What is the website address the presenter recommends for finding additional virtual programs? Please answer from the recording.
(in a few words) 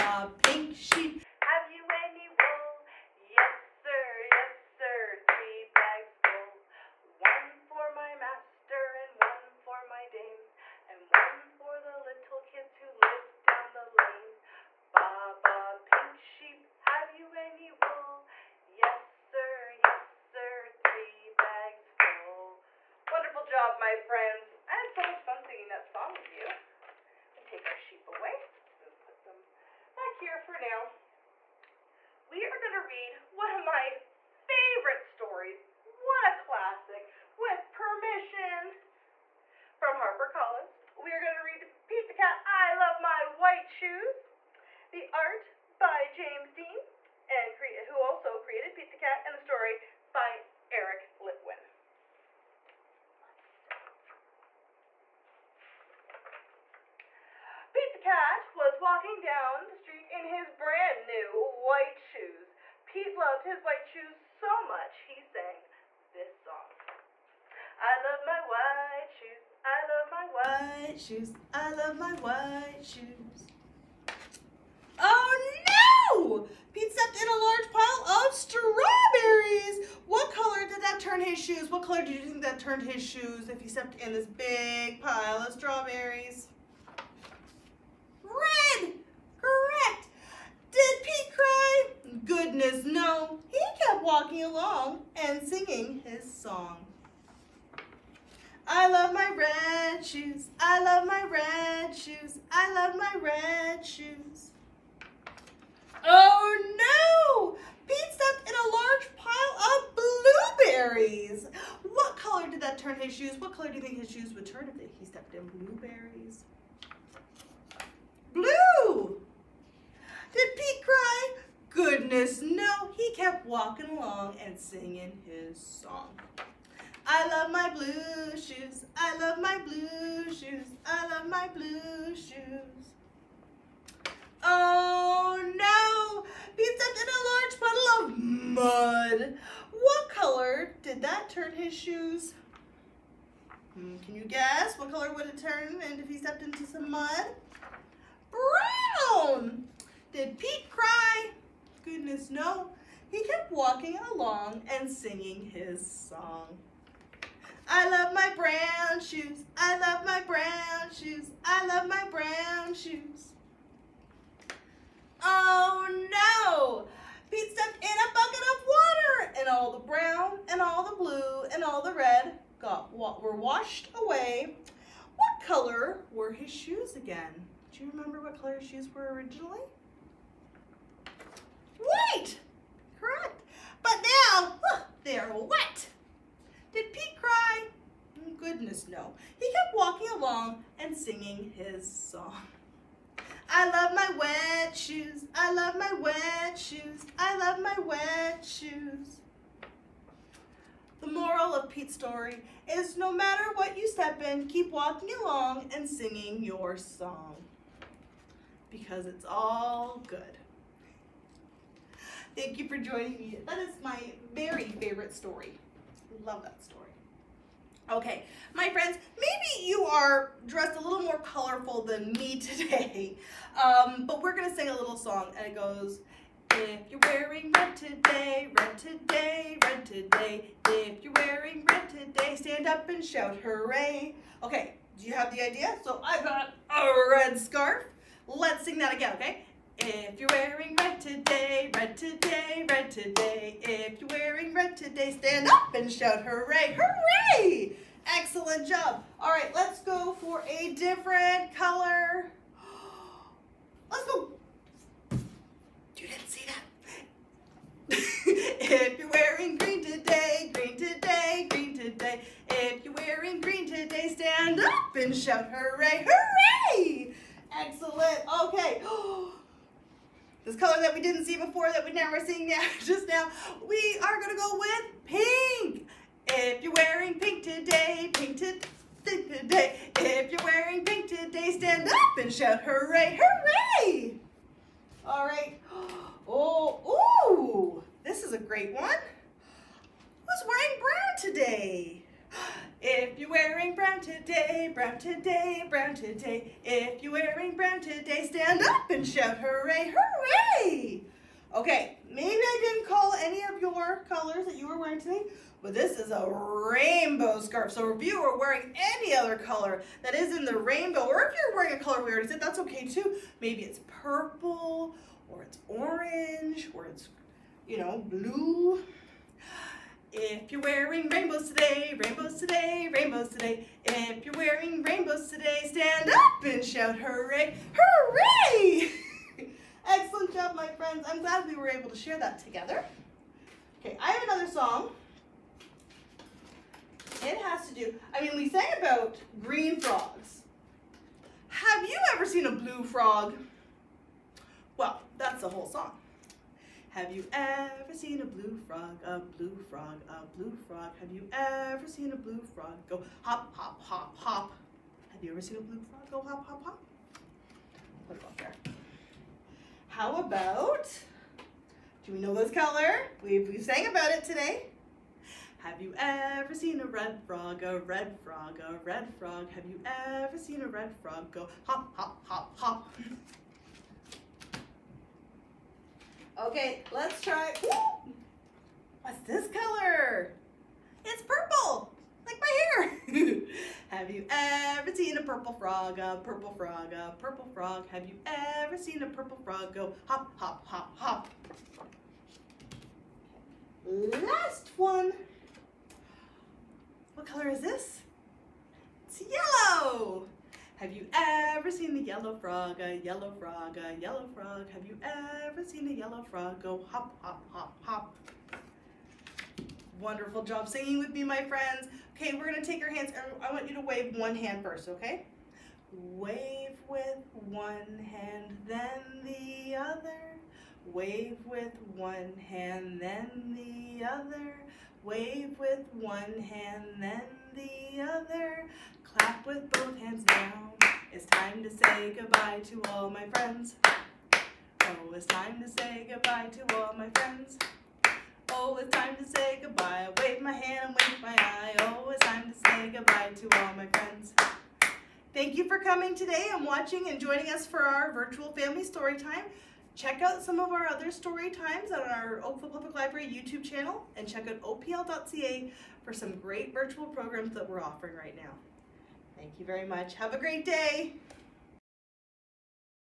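opl.ca.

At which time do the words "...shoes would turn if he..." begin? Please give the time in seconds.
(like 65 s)
114 s.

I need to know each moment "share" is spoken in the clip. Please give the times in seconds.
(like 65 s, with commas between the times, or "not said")
331 s.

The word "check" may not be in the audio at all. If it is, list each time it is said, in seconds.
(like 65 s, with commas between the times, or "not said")
449 s, 454 s.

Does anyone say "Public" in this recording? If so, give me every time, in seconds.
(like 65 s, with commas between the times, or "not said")
452 s.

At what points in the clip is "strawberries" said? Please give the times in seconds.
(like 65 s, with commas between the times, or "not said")
78 s, 85 s.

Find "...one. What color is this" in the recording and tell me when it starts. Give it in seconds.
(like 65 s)
394 s.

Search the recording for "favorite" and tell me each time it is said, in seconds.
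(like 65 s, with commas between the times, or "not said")
34 s, 214 s.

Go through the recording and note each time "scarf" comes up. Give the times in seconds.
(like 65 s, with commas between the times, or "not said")
237 s, 307 s.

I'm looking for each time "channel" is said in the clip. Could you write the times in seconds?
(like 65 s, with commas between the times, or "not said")
453 s.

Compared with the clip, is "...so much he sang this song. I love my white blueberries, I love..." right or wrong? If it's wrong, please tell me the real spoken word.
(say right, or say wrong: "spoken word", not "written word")
wrong: "shoes", not "blueberries".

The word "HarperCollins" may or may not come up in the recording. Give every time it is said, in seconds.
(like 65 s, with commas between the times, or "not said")
40 s.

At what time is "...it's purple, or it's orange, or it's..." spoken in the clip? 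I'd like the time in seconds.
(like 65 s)
313 s.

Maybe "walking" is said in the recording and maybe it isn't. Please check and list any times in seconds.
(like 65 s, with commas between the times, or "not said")
58 s, 94 s, 123 s, 153 s, 189 s, 204 s.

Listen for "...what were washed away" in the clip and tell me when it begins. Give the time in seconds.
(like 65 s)
172 s.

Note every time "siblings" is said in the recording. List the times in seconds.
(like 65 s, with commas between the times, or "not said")
not said.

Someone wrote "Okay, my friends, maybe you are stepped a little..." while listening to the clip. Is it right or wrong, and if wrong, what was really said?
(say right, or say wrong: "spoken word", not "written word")
wrong: "dressed", not "stepped".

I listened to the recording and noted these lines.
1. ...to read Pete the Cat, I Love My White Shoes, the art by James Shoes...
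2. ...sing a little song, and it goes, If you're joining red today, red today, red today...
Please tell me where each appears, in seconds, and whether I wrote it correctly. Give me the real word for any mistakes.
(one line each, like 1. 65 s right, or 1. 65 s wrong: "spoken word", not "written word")
1. 41 s wrong: "Dean", not "Shoes"
2. 224 s wrong: "wearing", not "joining".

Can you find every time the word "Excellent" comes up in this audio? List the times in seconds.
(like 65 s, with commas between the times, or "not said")
248 s, 267 s, 329 s.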